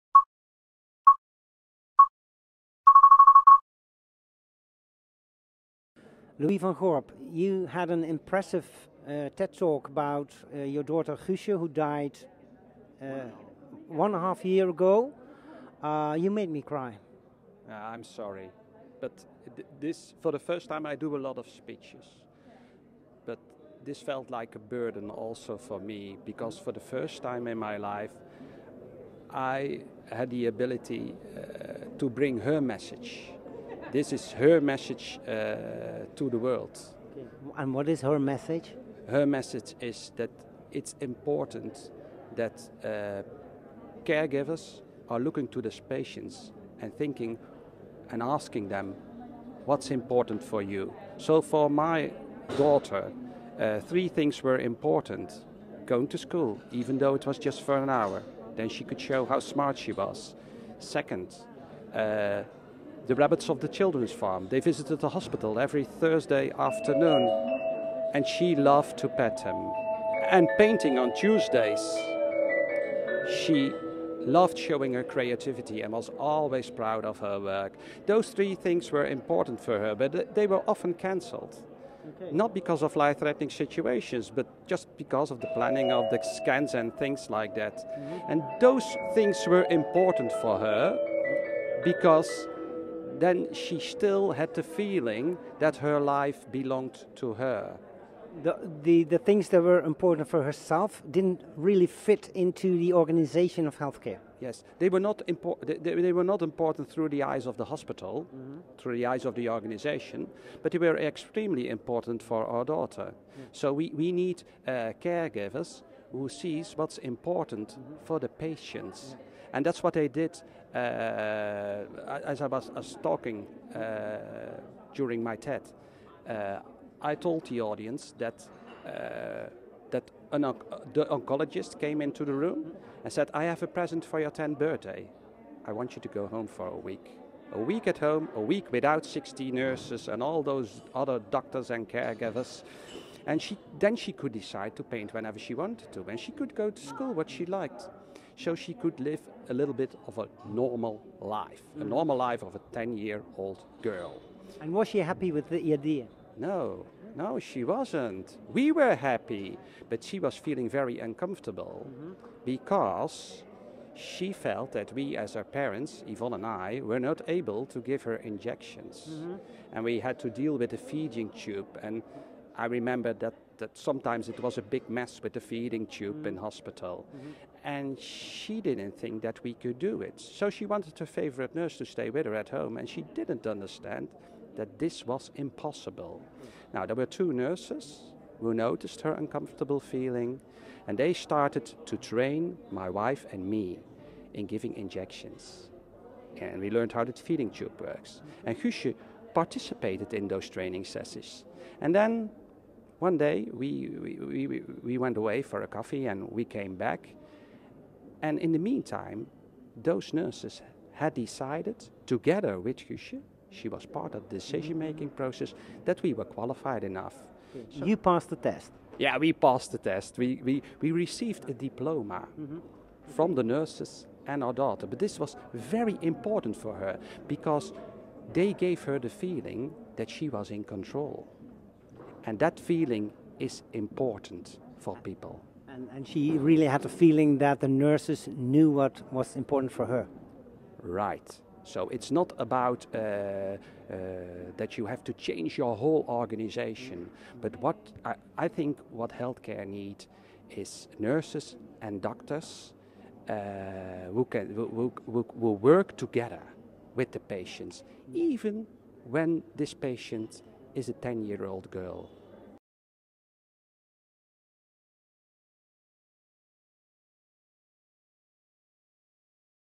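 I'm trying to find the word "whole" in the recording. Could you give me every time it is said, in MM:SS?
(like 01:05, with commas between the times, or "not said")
04:05.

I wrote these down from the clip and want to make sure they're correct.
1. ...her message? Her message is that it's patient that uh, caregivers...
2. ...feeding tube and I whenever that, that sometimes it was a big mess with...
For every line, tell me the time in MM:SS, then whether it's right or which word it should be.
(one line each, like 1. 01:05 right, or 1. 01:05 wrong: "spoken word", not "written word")
1. 00:38 wrong: "important", not "patient"
2. 02:50 wrong: "remember", not "whenever".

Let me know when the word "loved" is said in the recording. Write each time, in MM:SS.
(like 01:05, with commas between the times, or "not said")
01:08, 01:14.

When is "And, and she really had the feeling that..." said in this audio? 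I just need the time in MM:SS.
03:55.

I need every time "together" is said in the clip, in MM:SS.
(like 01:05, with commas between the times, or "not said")
03:32, 04:15.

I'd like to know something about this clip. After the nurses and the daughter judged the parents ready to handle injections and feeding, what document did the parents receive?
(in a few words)
A diploma.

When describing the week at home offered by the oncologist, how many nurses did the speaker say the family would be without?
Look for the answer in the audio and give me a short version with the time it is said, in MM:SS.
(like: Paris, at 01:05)
60, at 02:19.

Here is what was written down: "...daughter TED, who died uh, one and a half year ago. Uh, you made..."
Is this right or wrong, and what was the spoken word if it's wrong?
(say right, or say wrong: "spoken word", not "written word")
wrong: "Guusje", not "TED".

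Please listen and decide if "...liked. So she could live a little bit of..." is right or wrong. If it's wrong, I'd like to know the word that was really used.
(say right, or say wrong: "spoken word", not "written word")
right.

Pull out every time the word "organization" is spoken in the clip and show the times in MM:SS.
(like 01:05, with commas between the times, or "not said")
01:42, 01:49, 04:06.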